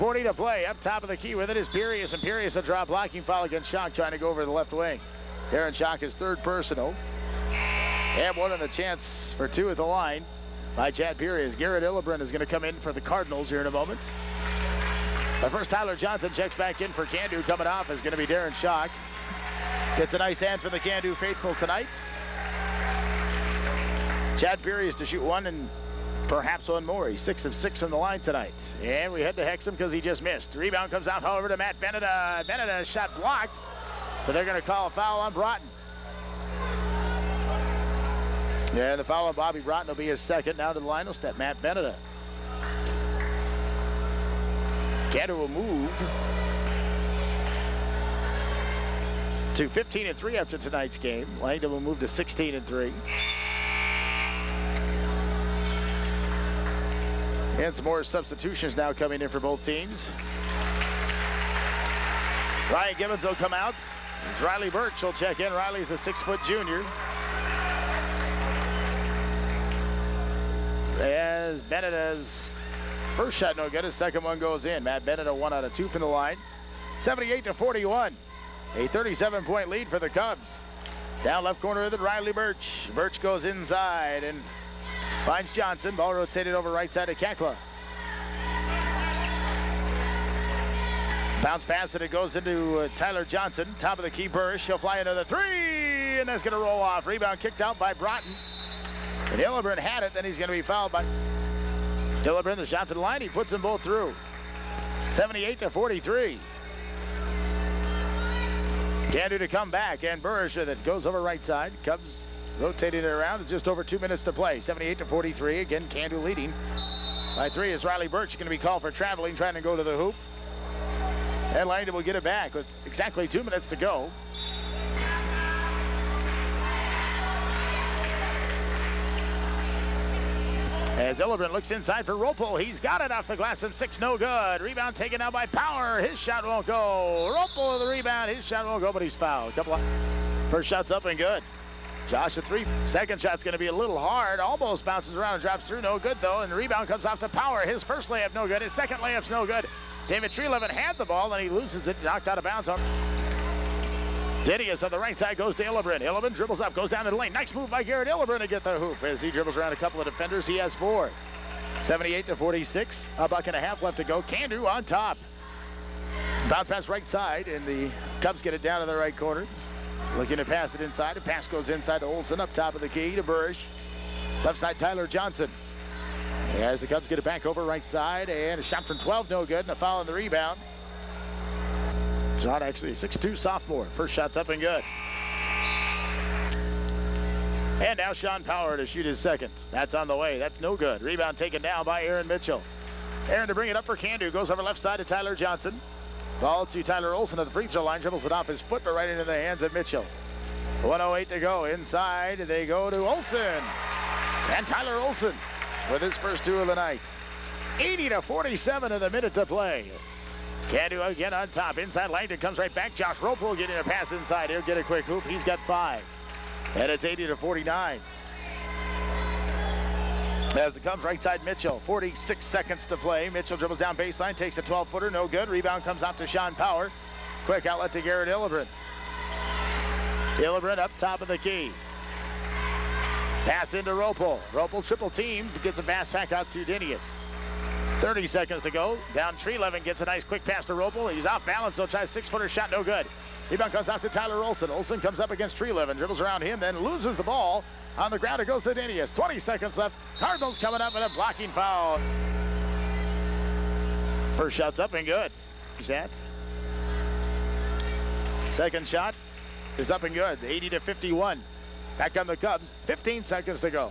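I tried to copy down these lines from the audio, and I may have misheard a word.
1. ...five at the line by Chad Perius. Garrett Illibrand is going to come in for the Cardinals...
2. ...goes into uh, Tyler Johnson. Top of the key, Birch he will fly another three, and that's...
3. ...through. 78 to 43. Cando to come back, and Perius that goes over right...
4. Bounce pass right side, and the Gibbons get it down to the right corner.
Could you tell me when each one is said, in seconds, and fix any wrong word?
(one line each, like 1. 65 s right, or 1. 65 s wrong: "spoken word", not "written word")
1. 9 s wrong: "two", not "five"
2. 92 s right
3. 103 s wrong: "Burrish", not "Perius"
4. 166 s wrong: "Cubs", not "Gibbons".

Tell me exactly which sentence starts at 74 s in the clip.
Matt Bennett a one out of two from the line.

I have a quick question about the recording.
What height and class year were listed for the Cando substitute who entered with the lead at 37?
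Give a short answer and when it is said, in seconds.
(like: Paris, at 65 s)
6-foot junior, at 65 s.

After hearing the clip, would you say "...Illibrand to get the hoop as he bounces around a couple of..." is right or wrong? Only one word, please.
wrong.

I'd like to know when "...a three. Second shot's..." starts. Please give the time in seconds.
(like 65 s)
142 s.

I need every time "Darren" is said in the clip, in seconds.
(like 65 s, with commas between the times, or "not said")
5 s, 18 s.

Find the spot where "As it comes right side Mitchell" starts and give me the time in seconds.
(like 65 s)
220 s.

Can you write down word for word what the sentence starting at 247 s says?
On the ground, it goes to Dinius.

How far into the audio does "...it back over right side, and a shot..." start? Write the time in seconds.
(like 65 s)
177 s.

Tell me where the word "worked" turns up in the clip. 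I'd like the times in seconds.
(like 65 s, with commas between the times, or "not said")
not said.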